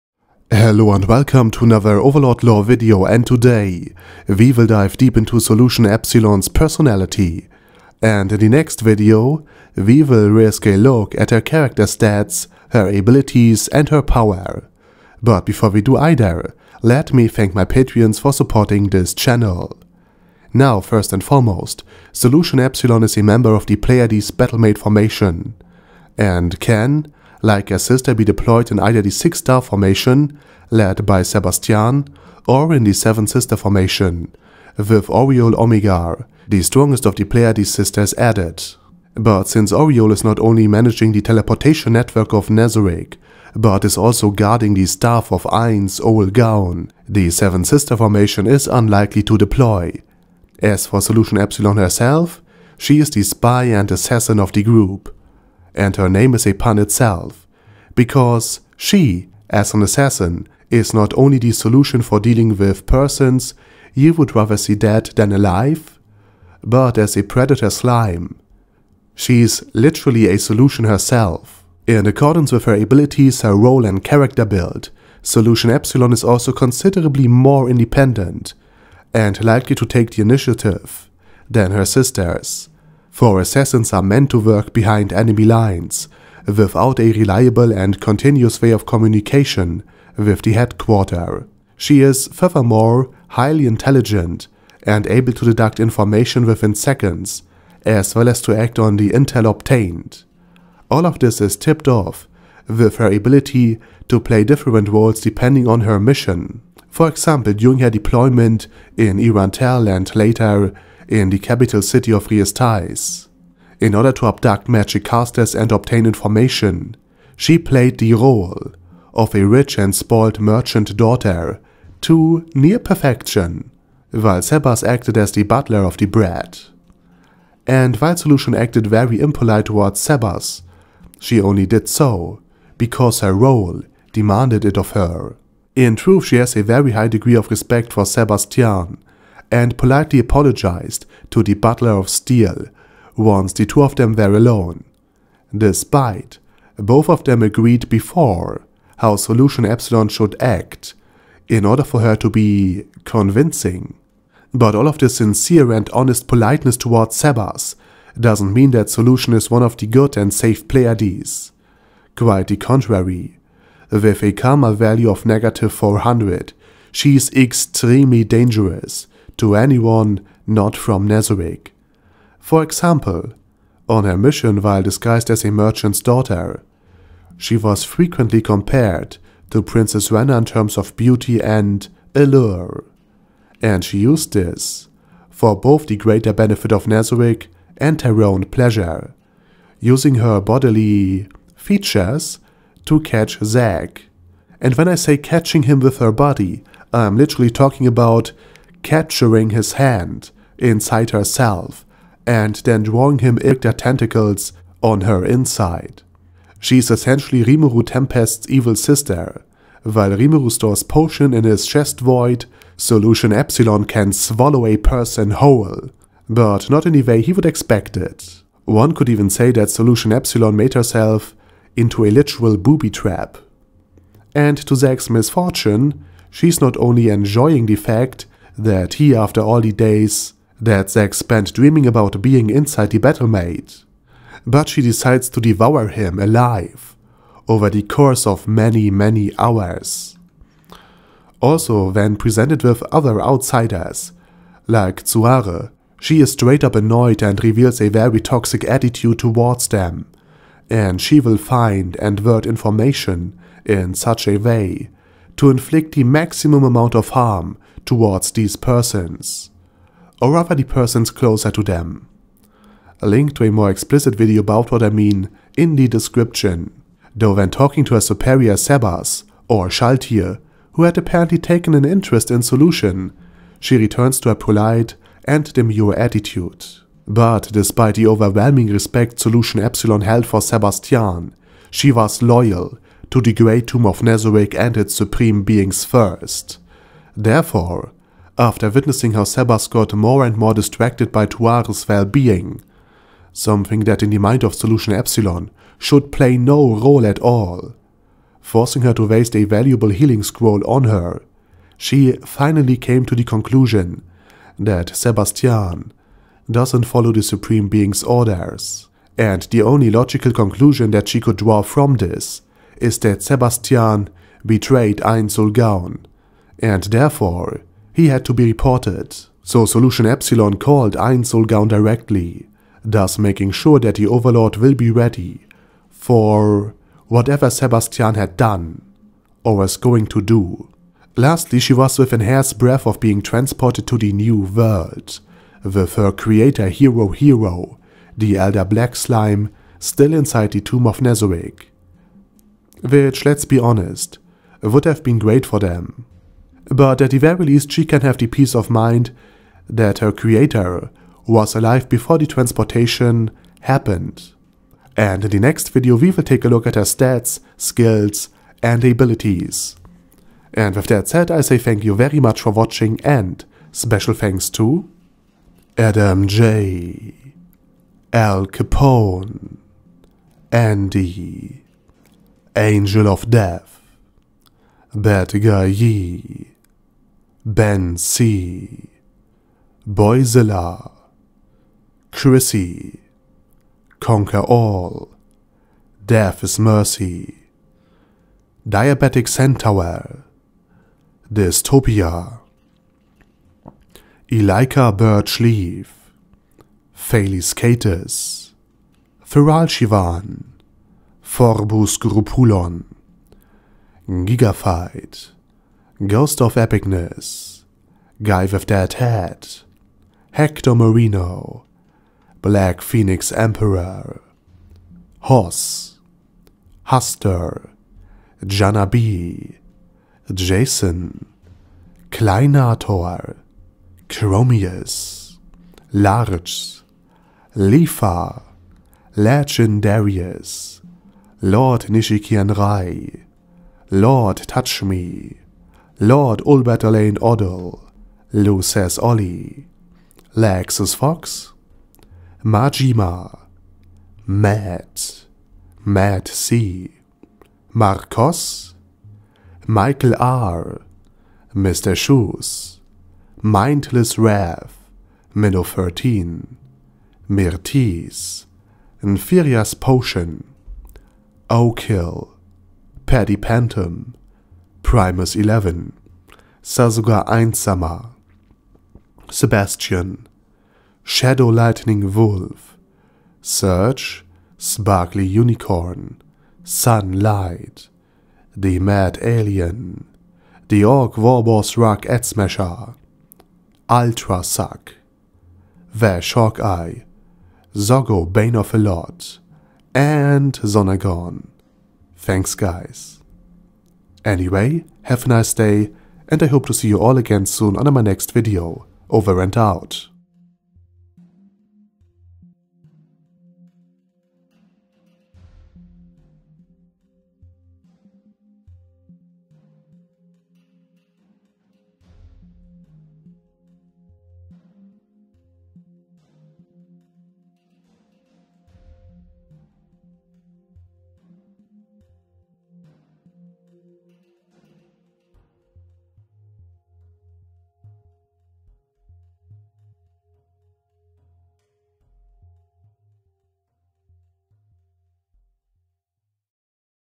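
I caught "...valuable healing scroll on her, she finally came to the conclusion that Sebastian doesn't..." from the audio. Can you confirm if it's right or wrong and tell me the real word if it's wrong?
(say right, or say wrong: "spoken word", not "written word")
right.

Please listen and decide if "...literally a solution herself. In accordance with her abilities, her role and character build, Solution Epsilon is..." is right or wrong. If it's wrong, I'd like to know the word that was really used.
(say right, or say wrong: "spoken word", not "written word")
right.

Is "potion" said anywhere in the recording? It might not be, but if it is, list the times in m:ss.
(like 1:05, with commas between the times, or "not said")
3:30, 7:39.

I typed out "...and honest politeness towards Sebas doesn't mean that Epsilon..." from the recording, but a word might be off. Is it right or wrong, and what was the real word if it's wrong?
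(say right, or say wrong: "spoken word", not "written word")
wrong: "Solution", not "Epsilon".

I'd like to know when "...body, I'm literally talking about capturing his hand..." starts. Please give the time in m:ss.
3:16.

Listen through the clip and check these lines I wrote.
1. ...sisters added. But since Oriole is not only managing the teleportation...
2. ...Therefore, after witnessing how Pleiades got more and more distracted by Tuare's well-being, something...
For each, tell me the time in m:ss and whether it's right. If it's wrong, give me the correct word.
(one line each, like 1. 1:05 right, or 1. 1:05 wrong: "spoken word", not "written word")
1. 0:37 right
2. 4:47 wrong: "Sebas", not "Pleiades".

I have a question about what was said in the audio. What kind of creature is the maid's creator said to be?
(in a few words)
Elder Black Slime.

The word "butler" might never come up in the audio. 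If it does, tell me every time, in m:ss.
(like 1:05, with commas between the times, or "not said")
2:05, 2:21.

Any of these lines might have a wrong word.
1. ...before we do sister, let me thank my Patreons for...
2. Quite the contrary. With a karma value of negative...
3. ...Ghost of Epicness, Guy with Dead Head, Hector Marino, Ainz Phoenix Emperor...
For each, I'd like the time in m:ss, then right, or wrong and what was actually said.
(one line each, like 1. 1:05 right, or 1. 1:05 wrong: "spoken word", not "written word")
1. 0:15 wrong: "either", not "sister"
2. 2:42 right
3. 6:46 wrong: "Black", not "Ainz".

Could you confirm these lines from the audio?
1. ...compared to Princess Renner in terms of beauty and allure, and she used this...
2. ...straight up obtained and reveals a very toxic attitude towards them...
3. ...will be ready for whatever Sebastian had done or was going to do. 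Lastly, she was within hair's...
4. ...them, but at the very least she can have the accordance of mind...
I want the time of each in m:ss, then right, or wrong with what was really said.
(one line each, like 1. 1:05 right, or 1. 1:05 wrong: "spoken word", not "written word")
1. 2:58 right
2. 4:06 wrong: "annoyed", not "obtained"
3. 5:24 right
4. 5:45 wrong: "peace", not "accordance".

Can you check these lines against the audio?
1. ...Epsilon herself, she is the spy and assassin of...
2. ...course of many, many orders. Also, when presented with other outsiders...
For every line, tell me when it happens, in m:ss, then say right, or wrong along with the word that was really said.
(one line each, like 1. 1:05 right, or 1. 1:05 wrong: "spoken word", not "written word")
1. 0:51 right
2. 3:57 wrong: "hours", not "orders".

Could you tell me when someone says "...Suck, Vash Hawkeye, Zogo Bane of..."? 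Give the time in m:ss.
8:04.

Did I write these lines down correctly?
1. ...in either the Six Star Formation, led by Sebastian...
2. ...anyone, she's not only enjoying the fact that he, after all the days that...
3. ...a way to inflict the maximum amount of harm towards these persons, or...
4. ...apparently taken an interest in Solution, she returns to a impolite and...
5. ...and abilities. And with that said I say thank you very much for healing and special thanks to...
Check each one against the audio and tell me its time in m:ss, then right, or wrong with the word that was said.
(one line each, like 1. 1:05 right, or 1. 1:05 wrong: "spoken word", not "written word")
1. 0:28 right
2. 3:45 wrong: "misfortune", not "anyone"
3. 4:14 right
4. 4:30 wrong: "polite", not "impolite"
5. 5:58 wrong: "watching", not "healing".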